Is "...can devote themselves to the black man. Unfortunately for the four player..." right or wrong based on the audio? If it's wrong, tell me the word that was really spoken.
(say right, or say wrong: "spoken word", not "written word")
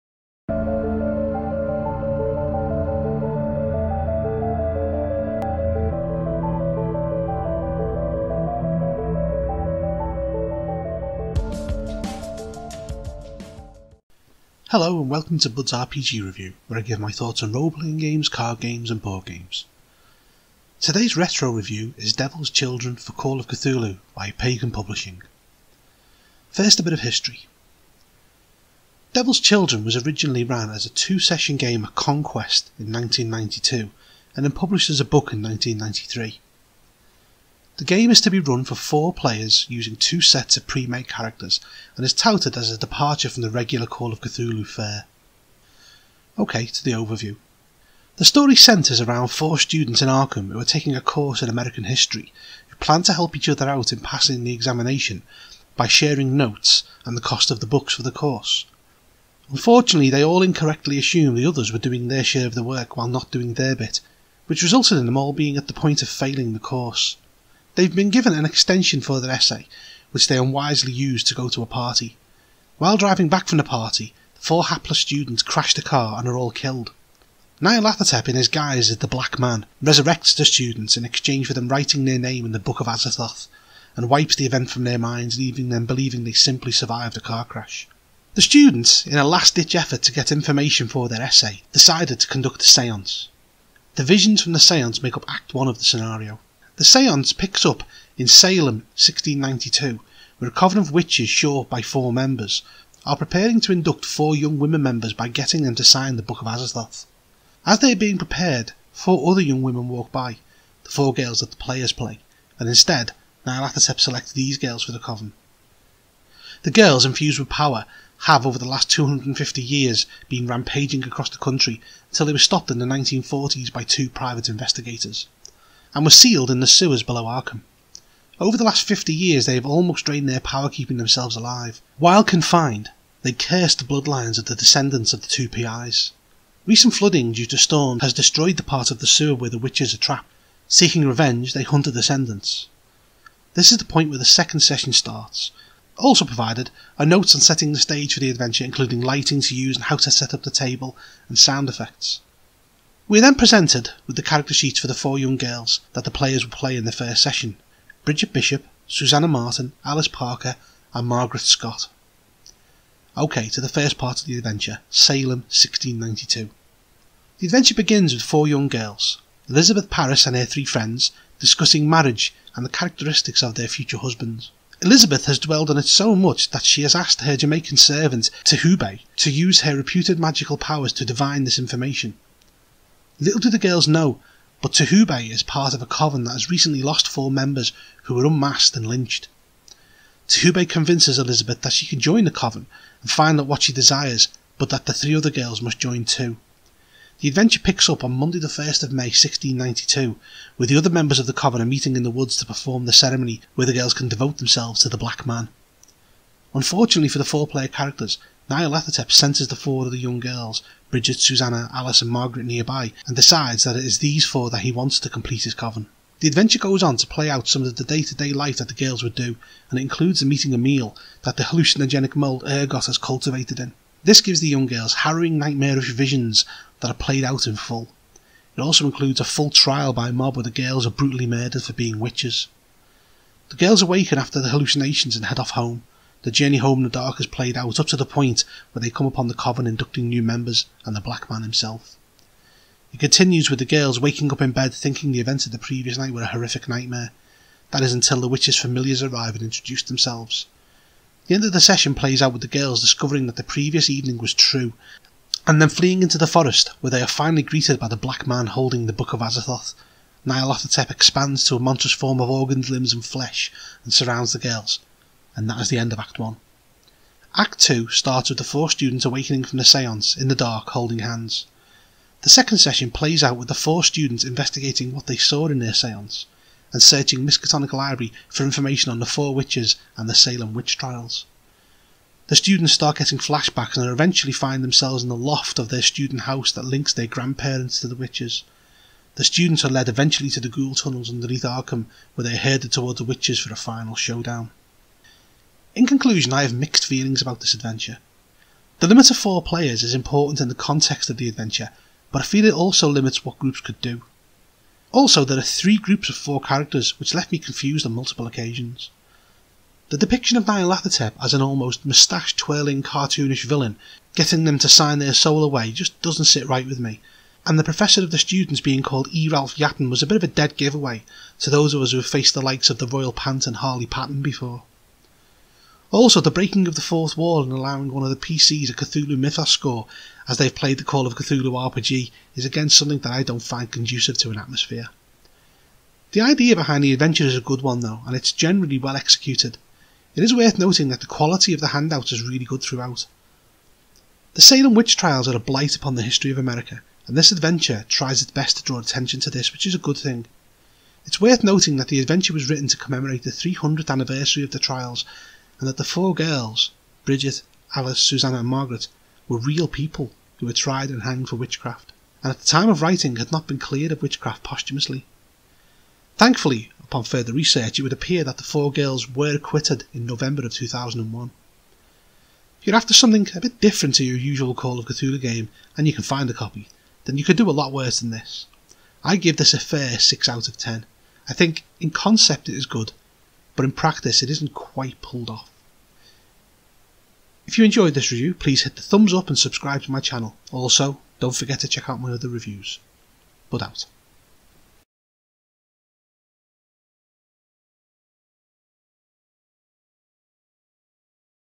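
right.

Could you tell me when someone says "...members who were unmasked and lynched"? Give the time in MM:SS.
03:07.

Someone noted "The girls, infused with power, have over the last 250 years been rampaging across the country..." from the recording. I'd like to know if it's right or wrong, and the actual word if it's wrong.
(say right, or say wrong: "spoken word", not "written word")
right.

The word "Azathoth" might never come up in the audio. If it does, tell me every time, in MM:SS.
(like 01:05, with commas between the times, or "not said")
01:22, 01:46, 04:19.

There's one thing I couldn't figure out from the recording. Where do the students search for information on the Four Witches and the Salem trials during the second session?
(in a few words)
Miskatonic Library.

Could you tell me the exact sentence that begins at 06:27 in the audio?
If you enjoyed this review, please hit the thumbs up and subscribe to my channel.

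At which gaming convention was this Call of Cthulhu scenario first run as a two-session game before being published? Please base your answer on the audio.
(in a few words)
Conquest.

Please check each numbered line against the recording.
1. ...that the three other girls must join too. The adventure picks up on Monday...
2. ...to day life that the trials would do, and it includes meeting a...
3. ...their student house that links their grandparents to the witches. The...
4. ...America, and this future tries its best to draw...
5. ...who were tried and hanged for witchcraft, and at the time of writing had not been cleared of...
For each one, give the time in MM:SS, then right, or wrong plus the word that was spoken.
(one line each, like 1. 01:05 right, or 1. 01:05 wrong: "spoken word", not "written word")
1. 03:14 right
2. 03:38 wrong: "girls", not "trials"
3. 04:45 right
4. 05:46 wrong: "adventure", not "future"
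5. 06:00 right.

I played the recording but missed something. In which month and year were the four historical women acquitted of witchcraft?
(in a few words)
November 2001.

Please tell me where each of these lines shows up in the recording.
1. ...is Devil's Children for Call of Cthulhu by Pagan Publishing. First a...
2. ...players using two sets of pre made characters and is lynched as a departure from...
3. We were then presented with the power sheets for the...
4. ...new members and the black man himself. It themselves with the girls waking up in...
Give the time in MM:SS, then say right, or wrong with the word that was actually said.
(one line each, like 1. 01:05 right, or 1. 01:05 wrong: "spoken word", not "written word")
1. 00:21 right
2. 00:39 wrong: "touted", not "lynched"
3. 02:33 wrong: "character", not "power"
4. 04:00 wrong: "continues", not "themselves".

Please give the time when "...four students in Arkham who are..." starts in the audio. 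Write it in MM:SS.
00:49.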